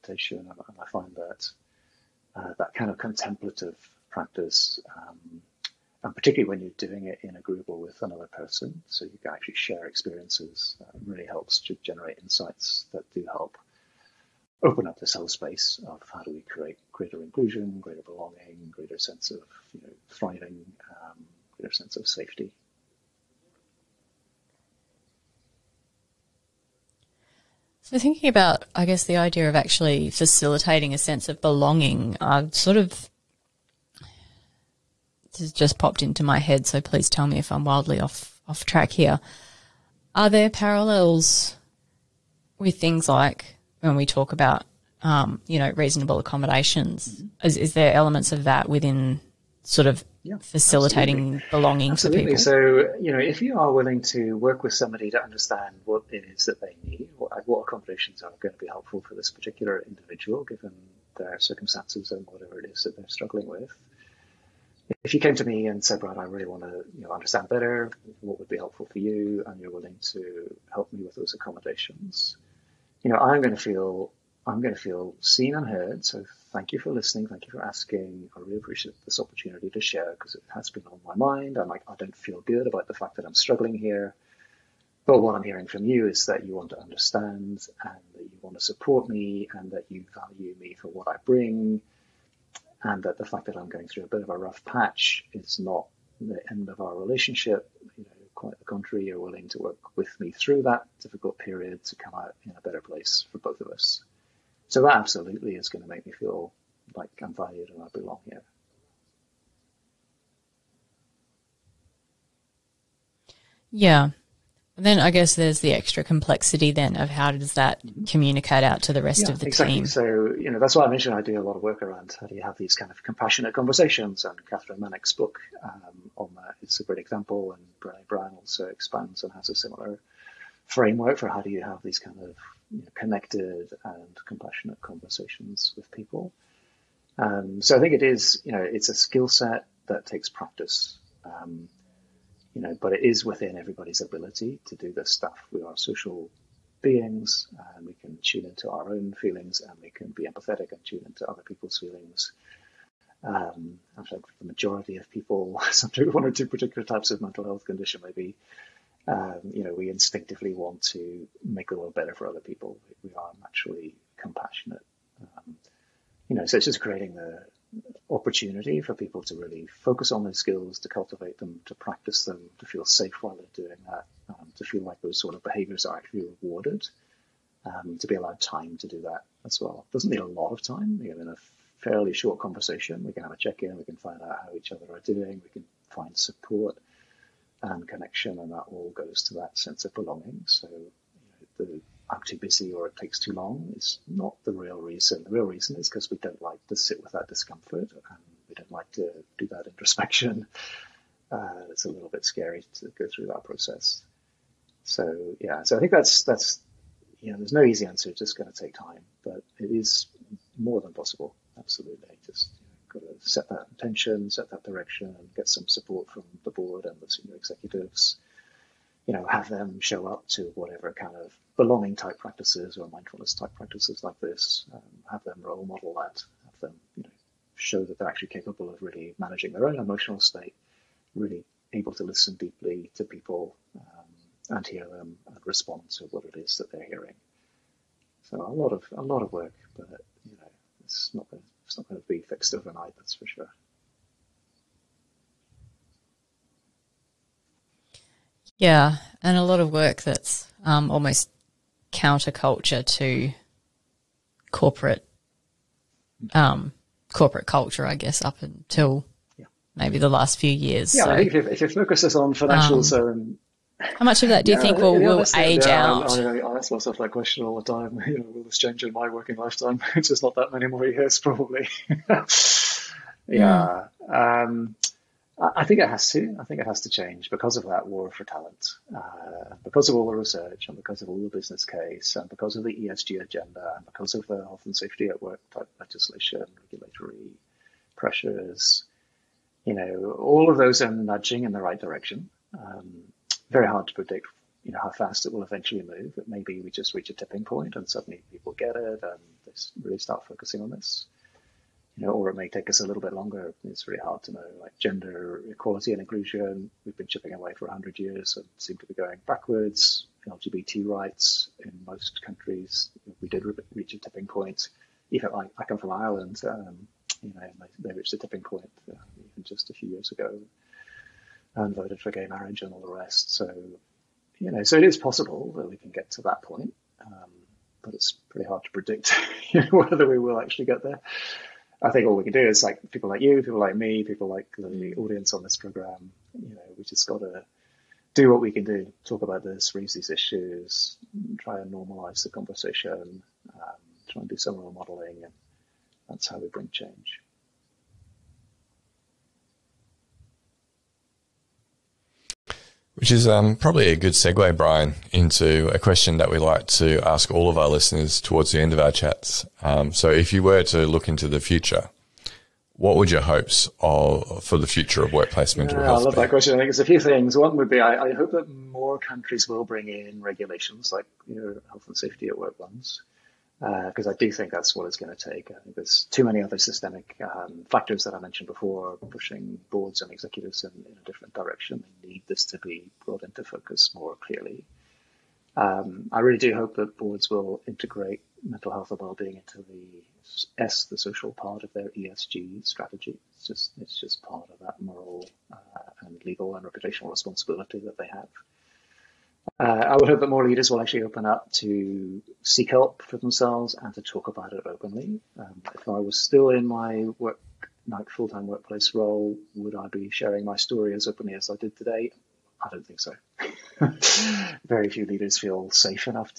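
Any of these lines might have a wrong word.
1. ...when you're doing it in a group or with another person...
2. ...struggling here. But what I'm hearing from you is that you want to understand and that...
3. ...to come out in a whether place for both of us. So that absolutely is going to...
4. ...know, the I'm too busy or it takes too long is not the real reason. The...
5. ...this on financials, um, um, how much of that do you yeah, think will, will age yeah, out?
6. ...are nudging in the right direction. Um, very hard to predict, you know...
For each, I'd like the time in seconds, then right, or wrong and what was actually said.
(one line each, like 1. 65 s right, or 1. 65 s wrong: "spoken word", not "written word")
1. 6 s right
2. 83 s right
3. 101 s wrong: "better", not "whether"
4. 191 s right
5. 262 s right
6. 290 s right.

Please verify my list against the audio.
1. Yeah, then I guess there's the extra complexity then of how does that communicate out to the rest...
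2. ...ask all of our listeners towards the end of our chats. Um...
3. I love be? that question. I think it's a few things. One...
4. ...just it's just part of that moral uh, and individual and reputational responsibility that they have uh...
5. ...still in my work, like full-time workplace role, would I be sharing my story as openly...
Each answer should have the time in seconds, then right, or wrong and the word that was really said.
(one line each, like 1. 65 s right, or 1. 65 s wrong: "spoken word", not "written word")
1. 113 s right
2. 357 s right
3. 366 s right
4. 393 s wrong: "legal", not "individual"
5. 406 s right.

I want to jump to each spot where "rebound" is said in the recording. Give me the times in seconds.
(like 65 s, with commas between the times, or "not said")
not said.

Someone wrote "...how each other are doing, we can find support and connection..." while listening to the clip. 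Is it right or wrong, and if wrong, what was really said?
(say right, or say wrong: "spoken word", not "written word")
right.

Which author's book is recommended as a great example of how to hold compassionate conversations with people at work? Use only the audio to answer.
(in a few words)
Kathryn Mannix.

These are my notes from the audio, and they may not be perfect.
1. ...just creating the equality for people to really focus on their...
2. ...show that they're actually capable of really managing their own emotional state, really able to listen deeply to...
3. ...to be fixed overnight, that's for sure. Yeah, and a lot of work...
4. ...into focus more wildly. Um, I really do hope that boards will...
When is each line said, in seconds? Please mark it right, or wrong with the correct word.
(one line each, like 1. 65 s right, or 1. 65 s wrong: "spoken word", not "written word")
1. 166 s wrong: "opportunity", not "equality"
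2. 227 s right
3. 242 s right
4. 383 s wrong: "clearly", not "wildly".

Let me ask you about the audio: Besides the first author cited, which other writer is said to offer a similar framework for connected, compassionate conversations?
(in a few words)
Brené Brown.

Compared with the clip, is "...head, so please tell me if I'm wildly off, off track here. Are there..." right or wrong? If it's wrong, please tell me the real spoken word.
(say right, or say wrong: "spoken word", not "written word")
right.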